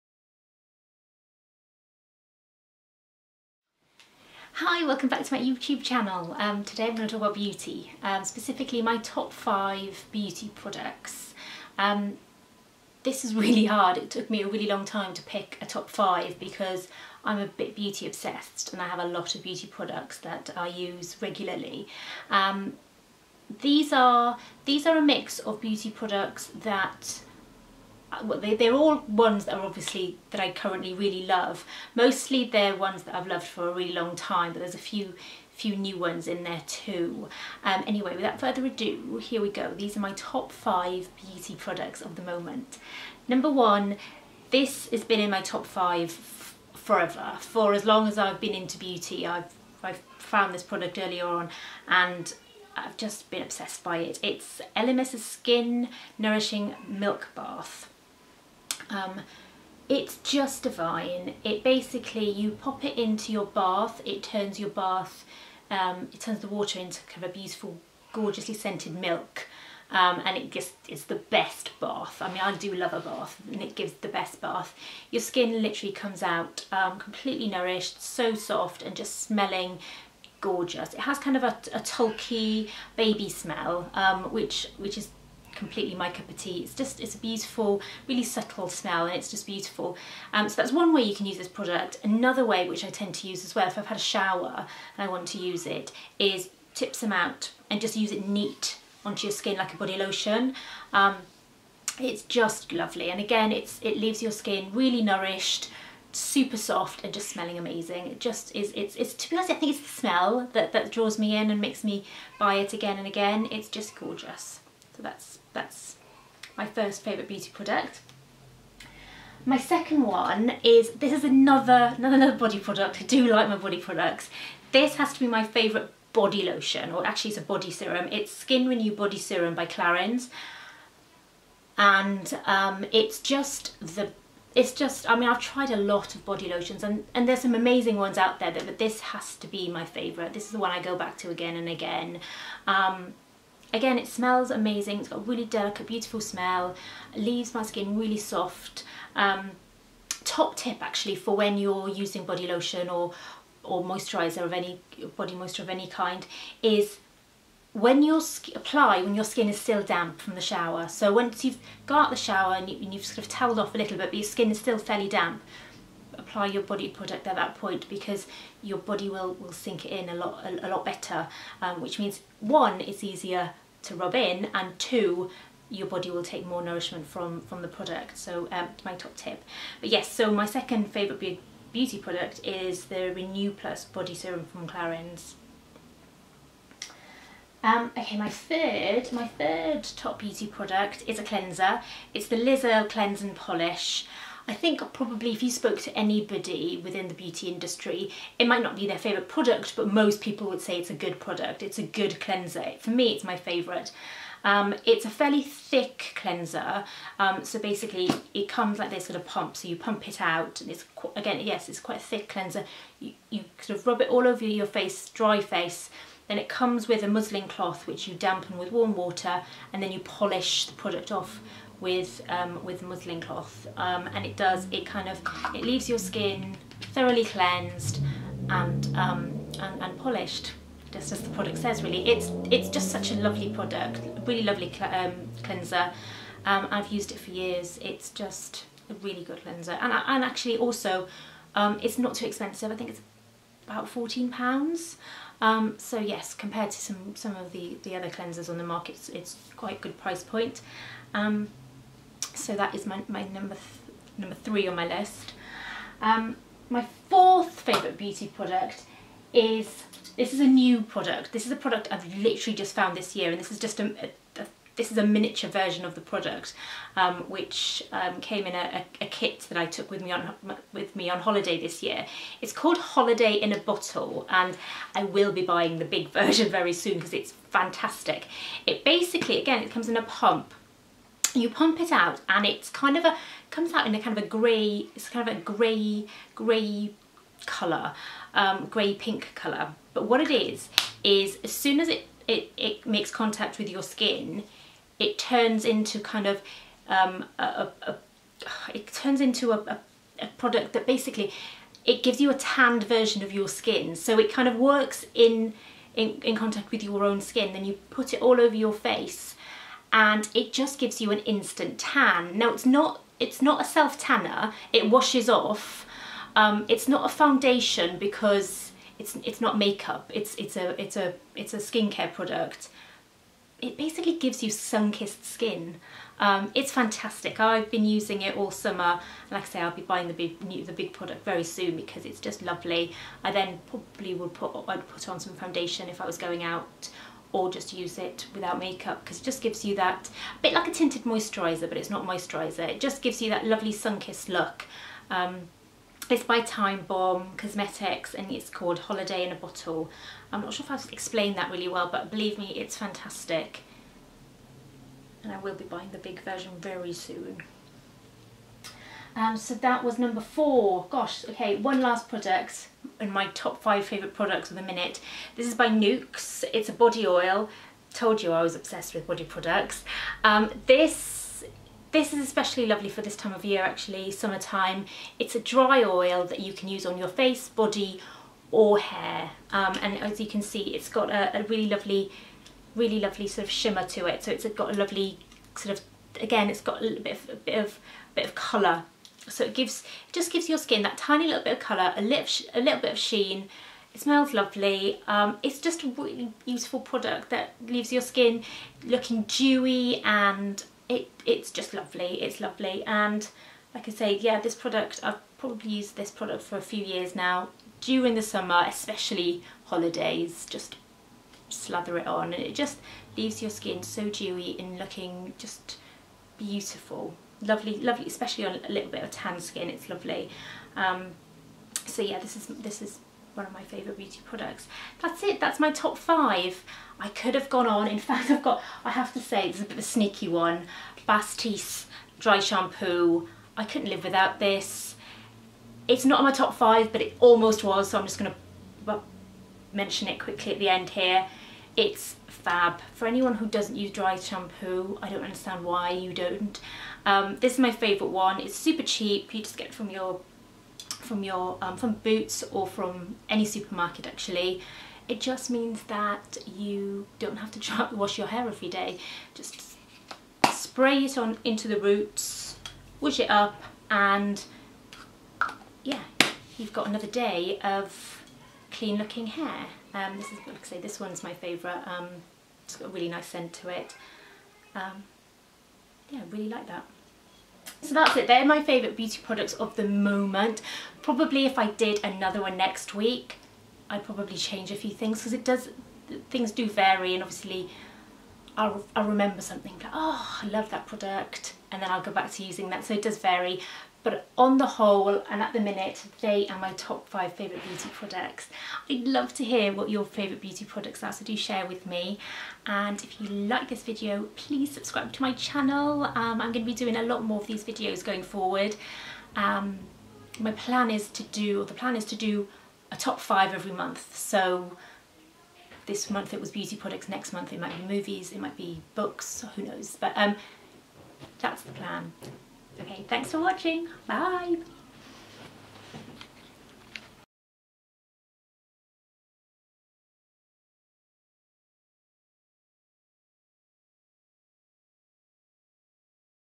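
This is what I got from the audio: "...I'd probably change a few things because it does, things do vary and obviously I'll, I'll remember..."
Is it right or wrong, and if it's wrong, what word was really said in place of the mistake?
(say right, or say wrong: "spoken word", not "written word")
right.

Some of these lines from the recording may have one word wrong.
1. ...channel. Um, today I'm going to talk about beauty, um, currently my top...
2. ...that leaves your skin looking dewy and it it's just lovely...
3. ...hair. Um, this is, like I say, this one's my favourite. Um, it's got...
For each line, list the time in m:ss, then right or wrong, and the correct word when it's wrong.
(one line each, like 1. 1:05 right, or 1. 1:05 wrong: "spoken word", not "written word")
1. 0:05 wrong: "specifically", not "currently"
2. 6:37 right
3. 7:49 right.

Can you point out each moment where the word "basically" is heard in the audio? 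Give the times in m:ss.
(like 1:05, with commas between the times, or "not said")
1:01, 3:27, 4:38, 5:00, 5:23.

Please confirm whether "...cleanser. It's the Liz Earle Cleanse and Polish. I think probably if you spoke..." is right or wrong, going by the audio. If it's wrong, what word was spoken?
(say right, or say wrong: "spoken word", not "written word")
right.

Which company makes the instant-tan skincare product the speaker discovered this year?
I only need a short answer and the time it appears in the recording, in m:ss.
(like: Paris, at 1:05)
Time Bomb Cosmetics, at 5:46.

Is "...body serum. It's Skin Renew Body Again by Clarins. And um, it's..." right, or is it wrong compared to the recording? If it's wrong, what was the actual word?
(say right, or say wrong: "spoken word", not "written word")
wrong: "Serum", not "Again".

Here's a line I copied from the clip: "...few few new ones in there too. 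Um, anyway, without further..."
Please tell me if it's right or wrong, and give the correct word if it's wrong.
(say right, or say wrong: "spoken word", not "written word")
right.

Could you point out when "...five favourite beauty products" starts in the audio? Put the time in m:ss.
8:17.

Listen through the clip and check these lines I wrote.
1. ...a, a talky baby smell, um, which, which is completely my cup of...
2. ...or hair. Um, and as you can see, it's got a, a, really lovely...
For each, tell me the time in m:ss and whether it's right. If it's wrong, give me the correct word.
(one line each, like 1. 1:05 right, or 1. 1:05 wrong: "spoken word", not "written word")
1. 1:21 right
2. 6:18 right.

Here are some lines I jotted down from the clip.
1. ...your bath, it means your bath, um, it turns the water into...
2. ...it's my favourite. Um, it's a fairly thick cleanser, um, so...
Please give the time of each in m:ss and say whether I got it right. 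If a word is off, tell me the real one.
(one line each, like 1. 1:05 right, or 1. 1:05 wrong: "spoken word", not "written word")
1. 1:03 wrong: "turns", not "means"
2. 3:23 right.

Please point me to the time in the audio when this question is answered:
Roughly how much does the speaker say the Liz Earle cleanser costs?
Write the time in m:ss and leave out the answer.
4:03.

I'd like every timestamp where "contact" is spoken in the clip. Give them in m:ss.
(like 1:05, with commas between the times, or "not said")
4:53, 5:06.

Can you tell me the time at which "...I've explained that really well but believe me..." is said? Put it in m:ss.
5:50.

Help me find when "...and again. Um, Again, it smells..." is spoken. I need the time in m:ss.
2:21.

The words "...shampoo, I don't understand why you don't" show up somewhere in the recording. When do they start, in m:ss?
7:24.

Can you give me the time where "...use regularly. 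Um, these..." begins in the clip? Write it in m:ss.
0:20.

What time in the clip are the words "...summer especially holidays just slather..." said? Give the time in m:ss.
6:48.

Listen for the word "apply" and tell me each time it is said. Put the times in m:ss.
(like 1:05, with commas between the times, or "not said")
2:38, 2:46.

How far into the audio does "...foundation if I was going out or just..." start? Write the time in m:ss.
5:35.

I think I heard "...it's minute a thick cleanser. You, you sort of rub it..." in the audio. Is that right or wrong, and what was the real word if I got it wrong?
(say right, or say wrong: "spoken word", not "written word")
wrong: "quite", not "minute".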